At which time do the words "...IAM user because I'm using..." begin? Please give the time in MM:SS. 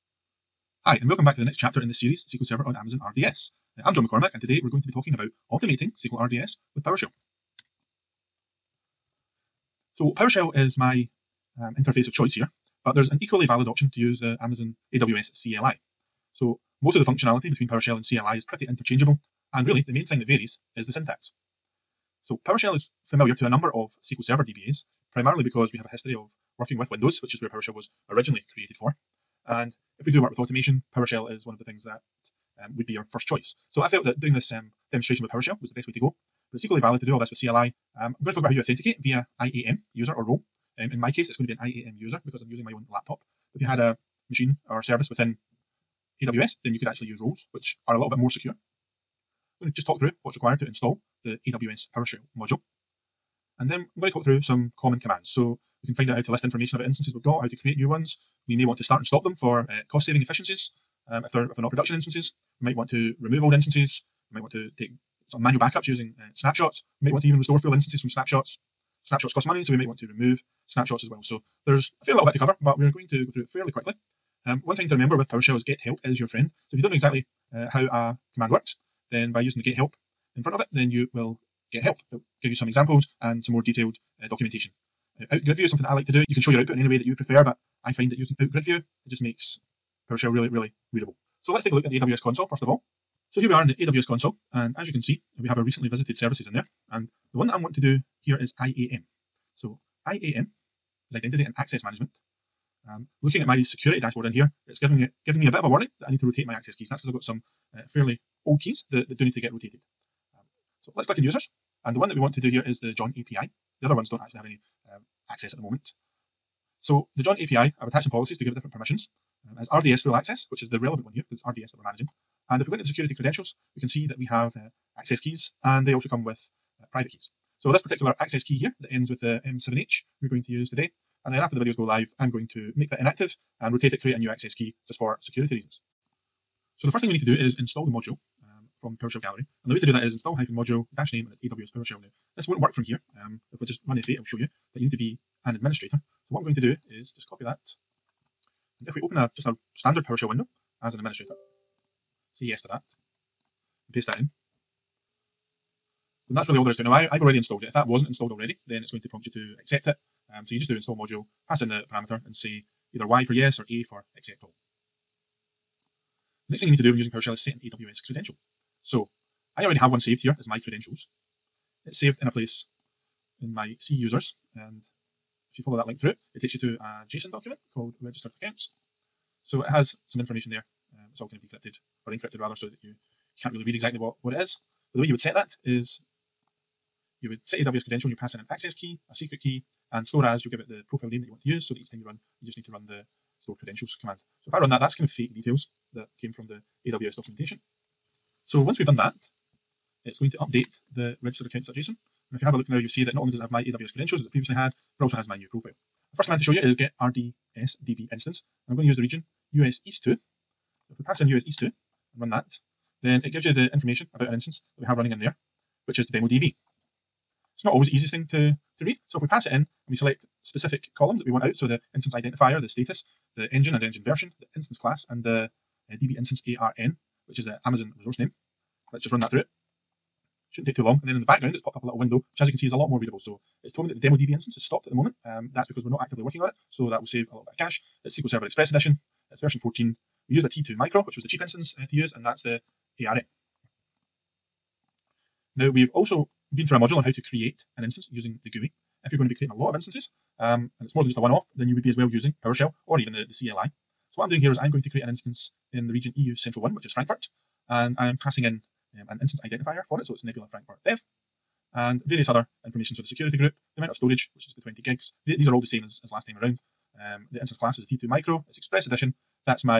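00:41.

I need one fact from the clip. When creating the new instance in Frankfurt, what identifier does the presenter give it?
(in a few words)
Nebula Frankfurt Dev.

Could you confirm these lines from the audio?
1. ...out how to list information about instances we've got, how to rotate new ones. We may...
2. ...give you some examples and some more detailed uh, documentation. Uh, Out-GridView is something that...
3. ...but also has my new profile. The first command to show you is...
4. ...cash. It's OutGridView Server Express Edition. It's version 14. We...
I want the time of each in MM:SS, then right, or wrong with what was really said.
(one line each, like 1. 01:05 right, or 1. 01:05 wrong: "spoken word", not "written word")
1. 00:56 wrong: "create", not "rotate"
2. 01:22 right
3. 03:24 right
4. 03:57 wrong: "SQL", not "OutGridView".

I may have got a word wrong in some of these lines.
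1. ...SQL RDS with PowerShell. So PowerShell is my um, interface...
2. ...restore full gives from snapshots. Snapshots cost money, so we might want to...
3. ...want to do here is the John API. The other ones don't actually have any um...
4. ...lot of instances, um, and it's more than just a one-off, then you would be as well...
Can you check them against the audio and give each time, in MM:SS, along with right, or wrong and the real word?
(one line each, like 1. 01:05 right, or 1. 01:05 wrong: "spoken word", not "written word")
1. 00:05 right
2. 01:07 wrong: "instances", not "gives"
3. 01:52 right
4. 04:09 right.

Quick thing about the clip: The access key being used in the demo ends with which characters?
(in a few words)
M7H.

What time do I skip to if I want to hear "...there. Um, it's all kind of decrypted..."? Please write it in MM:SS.
03:00.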